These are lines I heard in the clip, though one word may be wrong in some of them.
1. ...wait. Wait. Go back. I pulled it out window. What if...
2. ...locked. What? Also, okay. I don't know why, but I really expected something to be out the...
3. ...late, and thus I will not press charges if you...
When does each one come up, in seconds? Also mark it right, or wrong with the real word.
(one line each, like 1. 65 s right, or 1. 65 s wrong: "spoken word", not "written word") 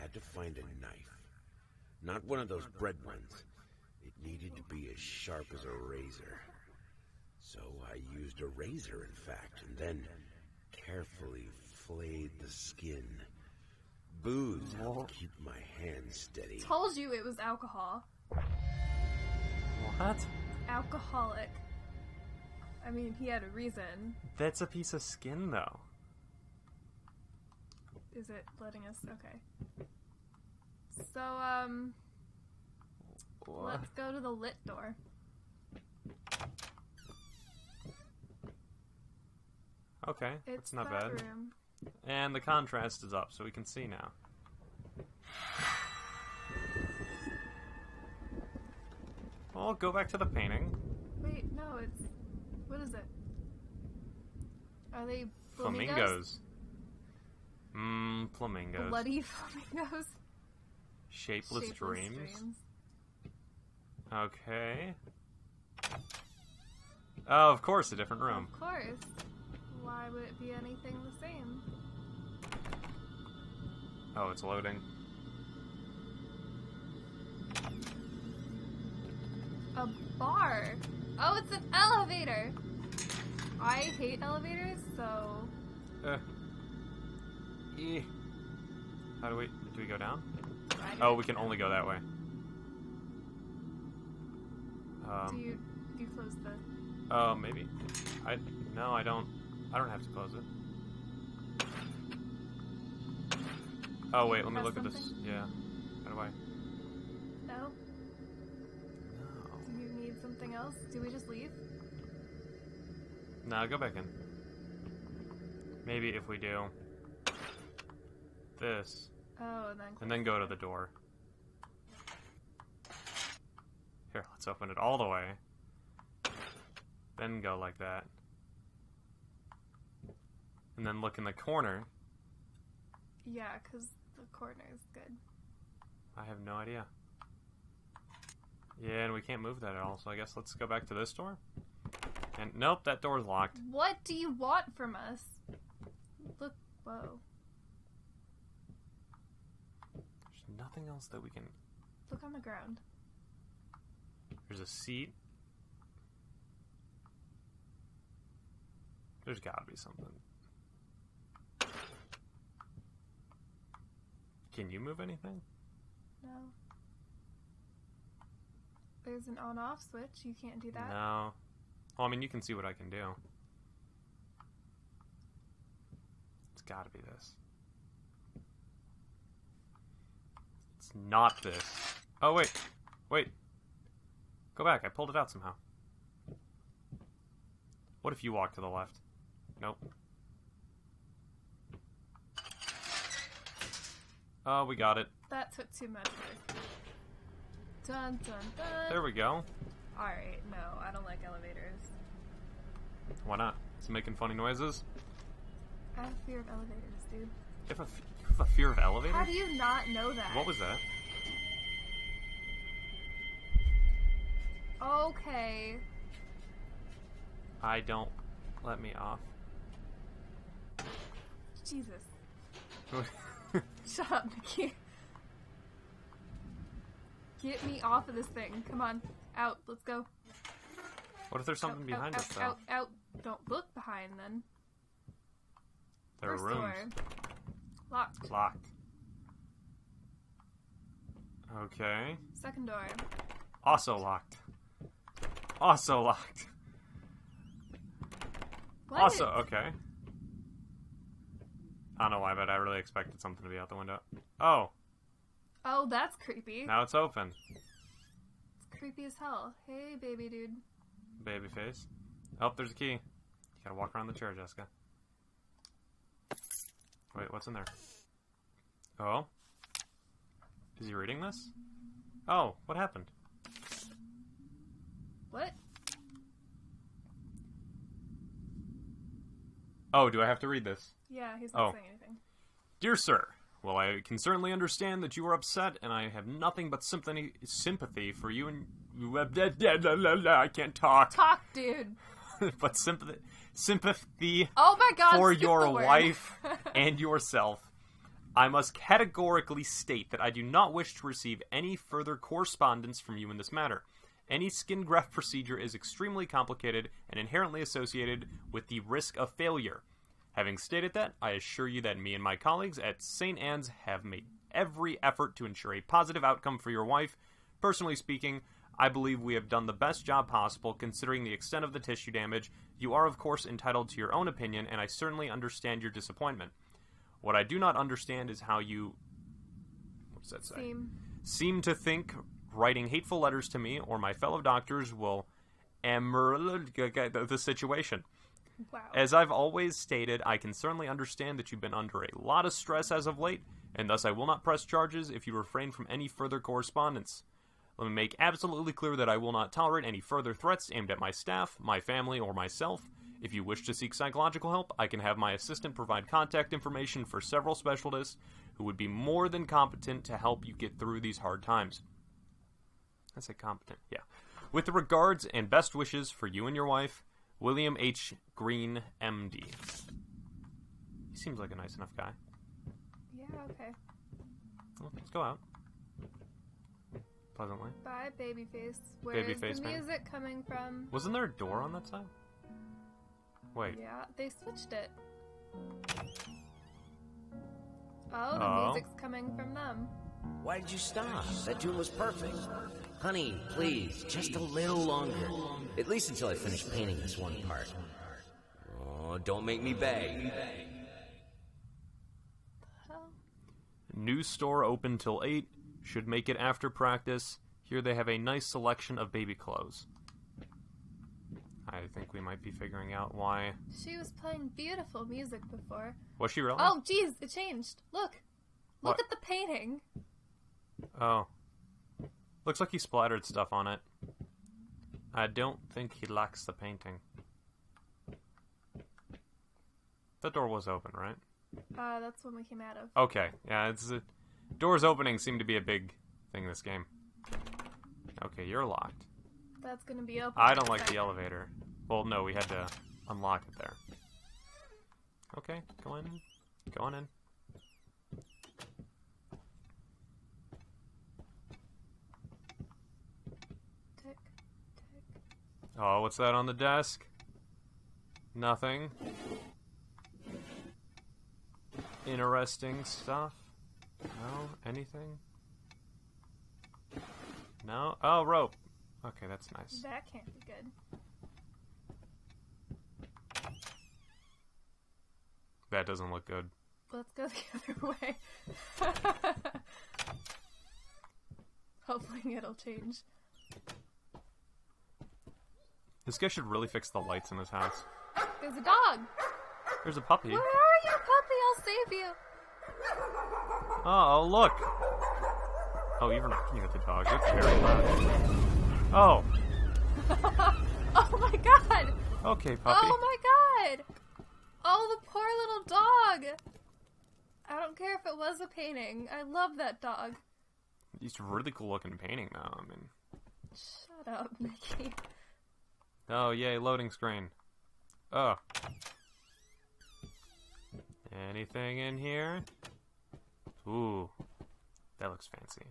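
1. 182 s wrong: "somehow", not "window"
2. 246 s right
3. 343 s right.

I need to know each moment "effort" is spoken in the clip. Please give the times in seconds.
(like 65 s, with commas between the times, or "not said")
315 s.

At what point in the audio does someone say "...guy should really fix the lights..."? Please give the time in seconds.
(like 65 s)
486 s.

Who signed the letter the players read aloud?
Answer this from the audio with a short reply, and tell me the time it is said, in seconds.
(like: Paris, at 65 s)
William H. Green, at 367 s.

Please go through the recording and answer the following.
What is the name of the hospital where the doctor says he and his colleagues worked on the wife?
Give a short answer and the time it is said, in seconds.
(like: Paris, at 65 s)
St. Anne's, at 313 s.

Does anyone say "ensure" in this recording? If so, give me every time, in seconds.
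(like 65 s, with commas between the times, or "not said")
315 s.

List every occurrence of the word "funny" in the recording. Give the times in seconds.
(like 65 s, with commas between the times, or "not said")
204 s.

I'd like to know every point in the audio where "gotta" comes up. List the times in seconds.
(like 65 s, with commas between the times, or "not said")
159 s, 176 s, 263 s.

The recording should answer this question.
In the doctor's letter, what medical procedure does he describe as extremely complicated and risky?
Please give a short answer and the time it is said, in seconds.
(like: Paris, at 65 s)
skin graft, at 304 s.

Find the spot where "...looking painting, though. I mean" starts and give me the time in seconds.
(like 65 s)
511 s.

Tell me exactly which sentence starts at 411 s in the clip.
I think we might be figuring out why.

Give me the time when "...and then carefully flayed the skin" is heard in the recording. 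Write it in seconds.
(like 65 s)
9 s.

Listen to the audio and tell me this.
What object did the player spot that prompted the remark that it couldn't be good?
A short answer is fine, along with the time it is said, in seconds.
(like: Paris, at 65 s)
rope, at 468 s.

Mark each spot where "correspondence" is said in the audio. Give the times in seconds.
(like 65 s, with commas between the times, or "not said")
302 s, 346 s.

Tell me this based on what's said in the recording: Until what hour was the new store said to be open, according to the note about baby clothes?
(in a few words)
8.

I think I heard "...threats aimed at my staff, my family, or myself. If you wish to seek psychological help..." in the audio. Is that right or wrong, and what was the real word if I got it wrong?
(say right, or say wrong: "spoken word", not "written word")
right.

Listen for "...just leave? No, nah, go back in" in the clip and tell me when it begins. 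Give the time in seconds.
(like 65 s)
111 s.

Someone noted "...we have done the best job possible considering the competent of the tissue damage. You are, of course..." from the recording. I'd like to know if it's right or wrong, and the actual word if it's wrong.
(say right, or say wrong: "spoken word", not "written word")
wrong: "extent", not "competent".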